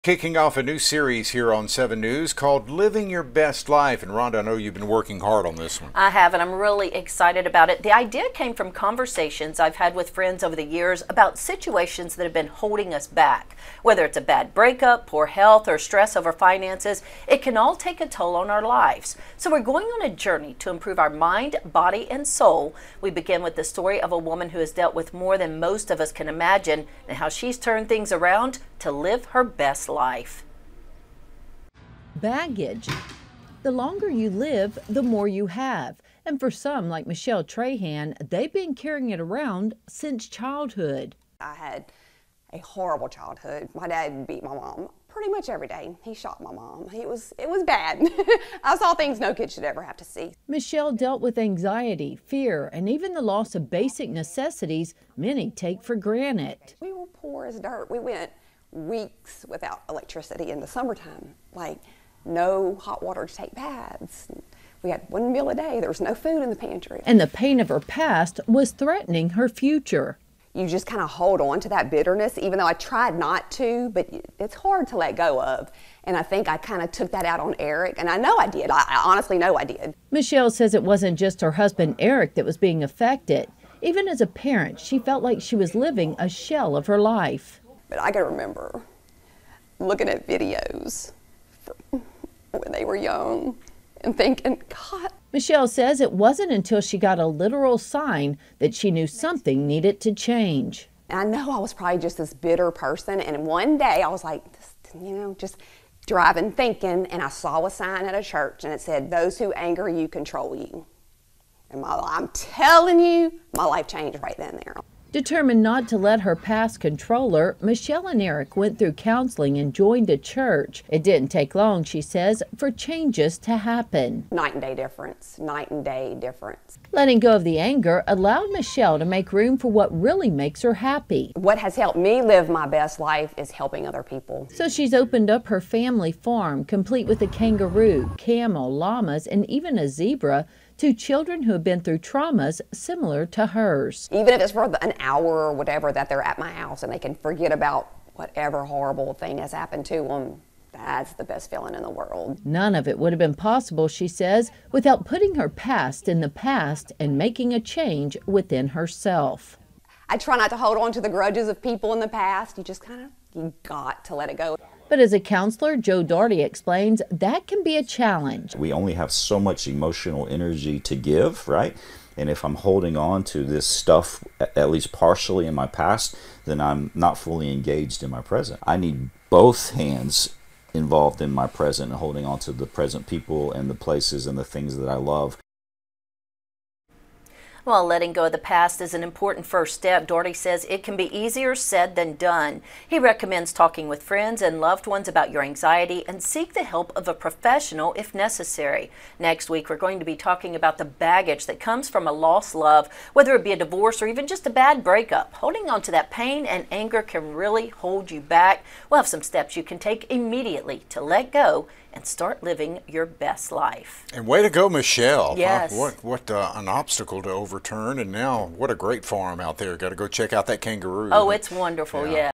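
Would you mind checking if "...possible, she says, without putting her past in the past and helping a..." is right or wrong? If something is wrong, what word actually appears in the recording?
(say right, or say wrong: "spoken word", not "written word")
wrong: "making", not "helping".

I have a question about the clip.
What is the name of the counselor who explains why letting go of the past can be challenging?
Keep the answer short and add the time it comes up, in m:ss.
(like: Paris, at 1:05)
Joe Doherty, at 2:45.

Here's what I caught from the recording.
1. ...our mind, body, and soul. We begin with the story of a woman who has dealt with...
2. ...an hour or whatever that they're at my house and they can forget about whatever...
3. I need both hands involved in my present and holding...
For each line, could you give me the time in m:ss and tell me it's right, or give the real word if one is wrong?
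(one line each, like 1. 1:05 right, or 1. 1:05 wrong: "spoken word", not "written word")
1. 0:20 right
2. 2:24 right
3. 2:58 right.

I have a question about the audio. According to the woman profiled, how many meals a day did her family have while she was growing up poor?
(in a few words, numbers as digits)
1.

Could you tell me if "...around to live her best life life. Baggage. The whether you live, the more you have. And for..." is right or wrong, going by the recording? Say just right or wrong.
wrong.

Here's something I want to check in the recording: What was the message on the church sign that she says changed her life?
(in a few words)
Those who anger you control you.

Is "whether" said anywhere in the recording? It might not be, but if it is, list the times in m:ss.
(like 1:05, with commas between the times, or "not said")
0:13, 3:23.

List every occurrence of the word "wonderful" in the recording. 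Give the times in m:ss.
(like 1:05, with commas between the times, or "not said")
3:41.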